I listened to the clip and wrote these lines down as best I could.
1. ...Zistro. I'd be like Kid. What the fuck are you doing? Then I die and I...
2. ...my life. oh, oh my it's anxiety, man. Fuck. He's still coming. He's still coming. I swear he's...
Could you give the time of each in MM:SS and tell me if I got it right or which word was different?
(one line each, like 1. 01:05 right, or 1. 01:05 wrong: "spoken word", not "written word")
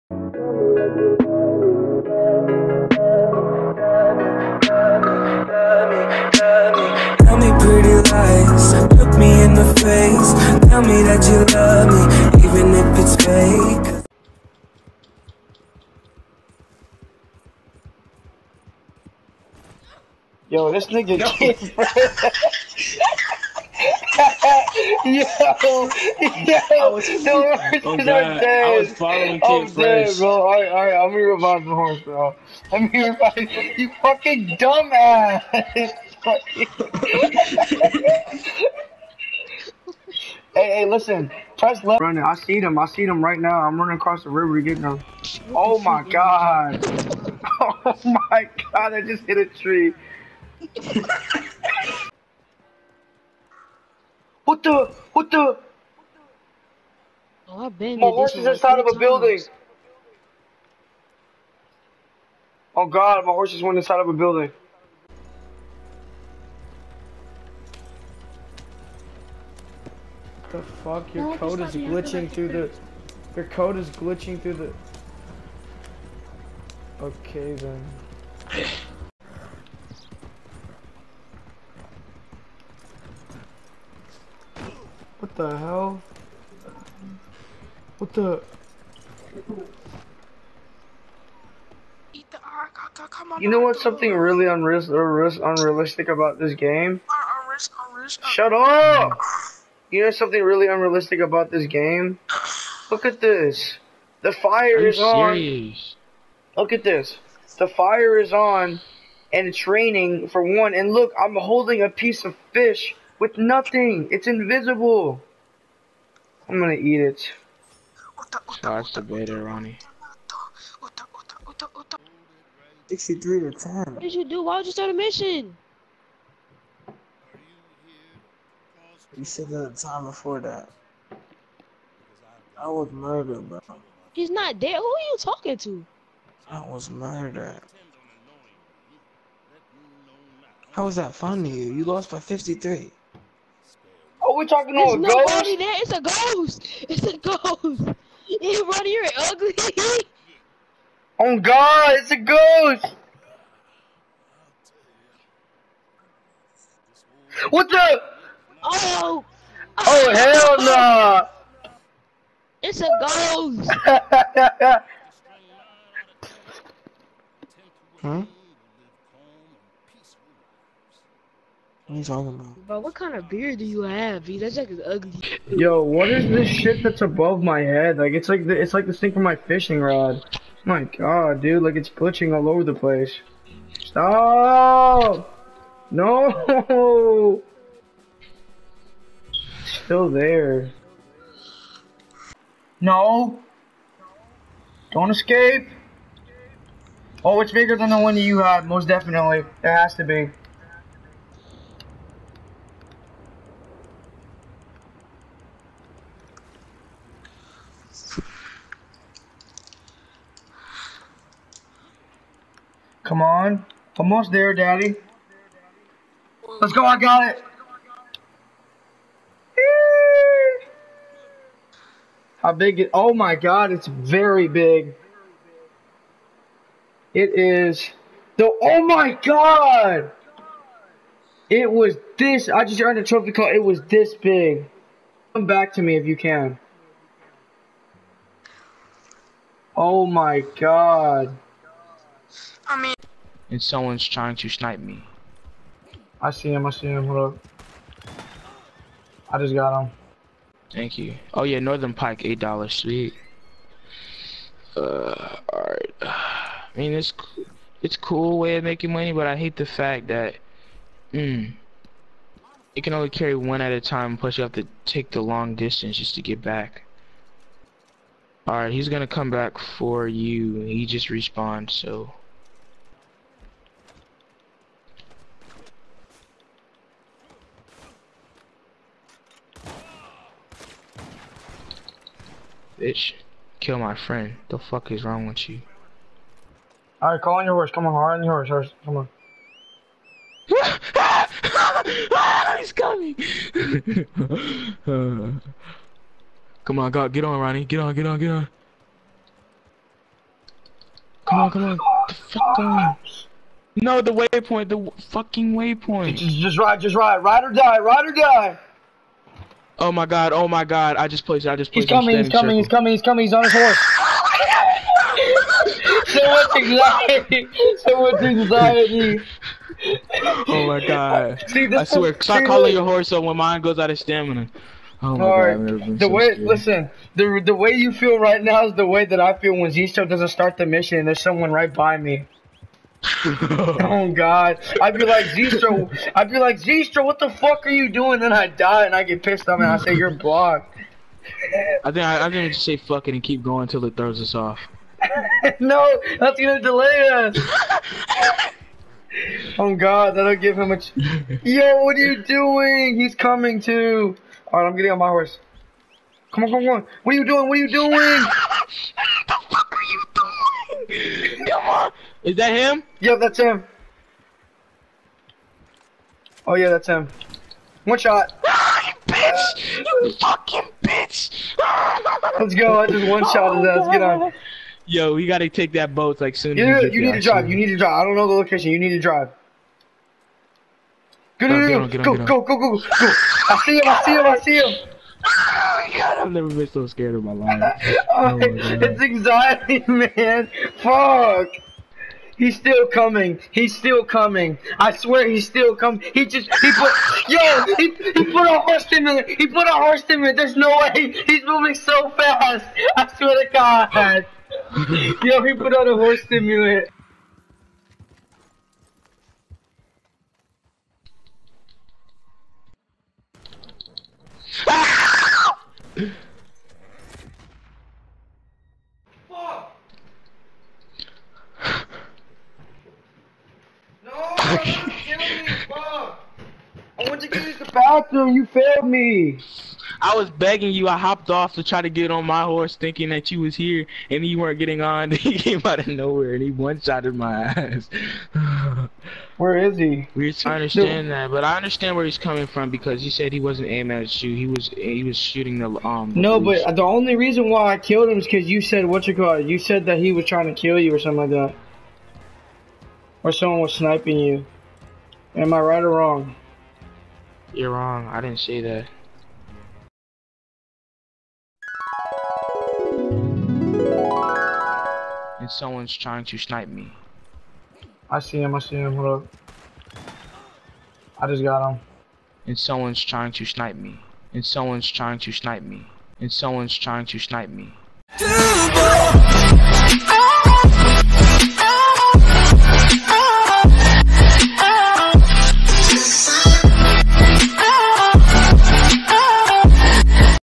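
1. 05:35 wrong: "Zistro", not "Kid"
2. 06:27 right.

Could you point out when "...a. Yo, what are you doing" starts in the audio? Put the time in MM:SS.
05:50.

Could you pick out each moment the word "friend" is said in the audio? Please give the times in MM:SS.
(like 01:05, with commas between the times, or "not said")
04:43.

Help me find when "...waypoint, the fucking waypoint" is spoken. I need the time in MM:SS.
05:04.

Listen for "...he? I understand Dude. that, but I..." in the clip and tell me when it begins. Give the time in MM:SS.
07:19.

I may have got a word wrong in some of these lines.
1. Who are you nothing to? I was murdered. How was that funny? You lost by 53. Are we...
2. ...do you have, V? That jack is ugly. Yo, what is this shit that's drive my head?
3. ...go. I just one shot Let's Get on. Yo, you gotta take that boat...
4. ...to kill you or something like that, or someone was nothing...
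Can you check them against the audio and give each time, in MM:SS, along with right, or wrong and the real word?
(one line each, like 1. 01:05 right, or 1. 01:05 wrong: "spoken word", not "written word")
1. 02:14 wrong: "talking", not "nothing"
2. 02:53 wrong: "above", not "drive"
3. 06:12 right
4. 07:30 wrong: "sniping", not "nothing".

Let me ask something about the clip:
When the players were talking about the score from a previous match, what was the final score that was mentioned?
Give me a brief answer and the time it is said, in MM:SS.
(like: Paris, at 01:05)
63 to 10, at 02:02.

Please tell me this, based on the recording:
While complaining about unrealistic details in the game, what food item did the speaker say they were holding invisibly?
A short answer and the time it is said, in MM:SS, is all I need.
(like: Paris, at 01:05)
fish, at 01:51.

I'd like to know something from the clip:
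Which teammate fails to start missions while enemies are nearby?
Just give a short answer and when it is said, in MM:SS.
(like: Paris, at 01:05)
Zisto, at 05:29.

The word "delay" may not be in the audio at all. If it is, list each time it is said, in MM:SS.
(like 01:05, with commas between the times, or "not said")
05:46.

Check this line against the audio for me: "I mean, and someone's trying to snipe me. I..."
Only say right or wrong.
right.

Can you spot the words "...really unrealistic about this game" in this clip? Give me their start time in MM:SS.
01:40.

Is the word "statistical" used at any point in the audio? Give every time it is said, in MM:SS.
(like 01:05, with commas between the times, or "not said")
not said.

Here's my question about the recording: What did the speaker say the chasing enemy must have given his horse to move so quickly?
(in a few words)
horse stimulant.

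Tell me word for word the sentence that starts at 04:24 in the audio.
Plus, you have to take the long distance just to get back.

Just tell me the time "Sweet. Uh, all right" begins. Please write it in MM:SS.
04:12.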